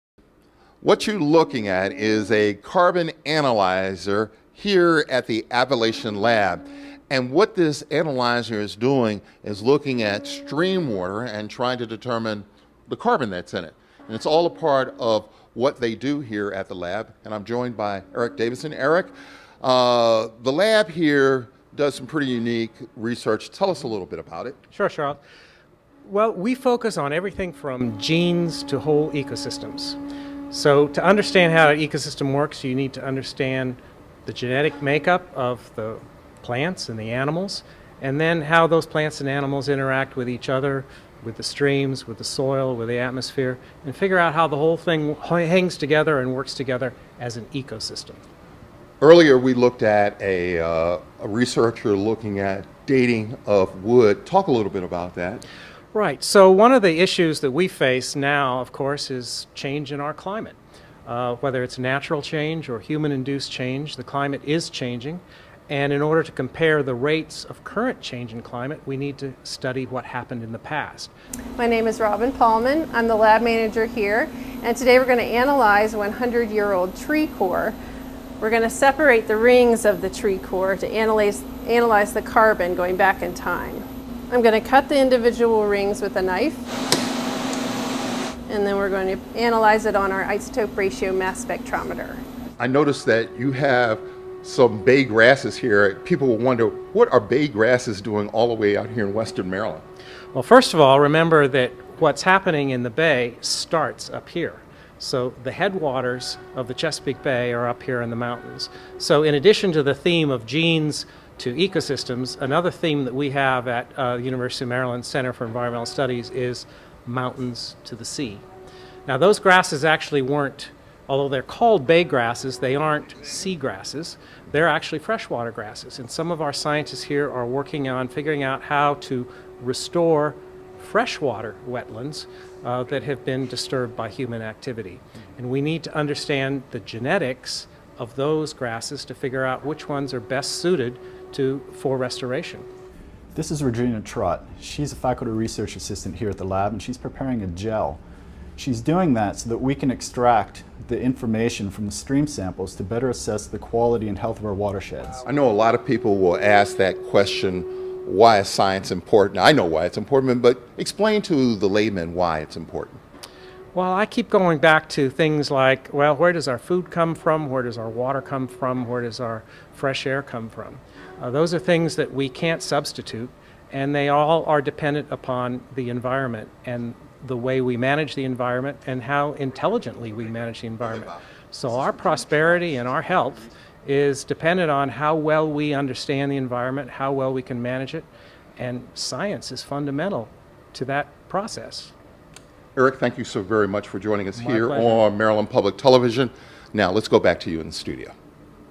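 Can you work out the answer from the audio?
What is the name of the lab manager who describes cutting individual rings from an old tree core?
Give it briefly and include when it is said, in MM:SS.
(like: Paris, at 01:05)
Robin Paulman, at 01:11.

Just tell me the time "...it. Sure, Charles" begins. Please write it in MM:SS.
00:24.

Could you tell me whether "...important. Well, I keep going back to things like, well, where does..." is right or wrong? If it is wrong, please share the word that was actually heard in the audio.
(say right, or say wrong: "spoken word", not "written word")
right.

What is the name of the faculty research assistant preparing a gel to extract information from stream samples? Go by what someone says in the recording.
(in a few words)
Regina Trott.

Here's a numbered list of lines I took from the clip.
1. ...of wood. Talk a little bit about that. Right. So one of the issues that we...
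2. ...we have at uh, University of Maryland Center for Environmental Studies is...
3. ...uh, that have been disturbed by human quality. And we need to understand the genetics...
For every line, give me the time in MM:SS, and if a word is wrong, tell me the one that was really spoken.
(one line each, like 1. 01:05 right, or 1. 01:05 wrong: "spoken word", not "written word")
1. 00:53 right
2. 01:53 right
3. 02:12 wrong: "activity", not "quality".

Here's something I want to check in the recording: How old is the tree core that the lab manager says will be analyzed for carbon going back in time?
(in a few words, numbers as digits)
100 years.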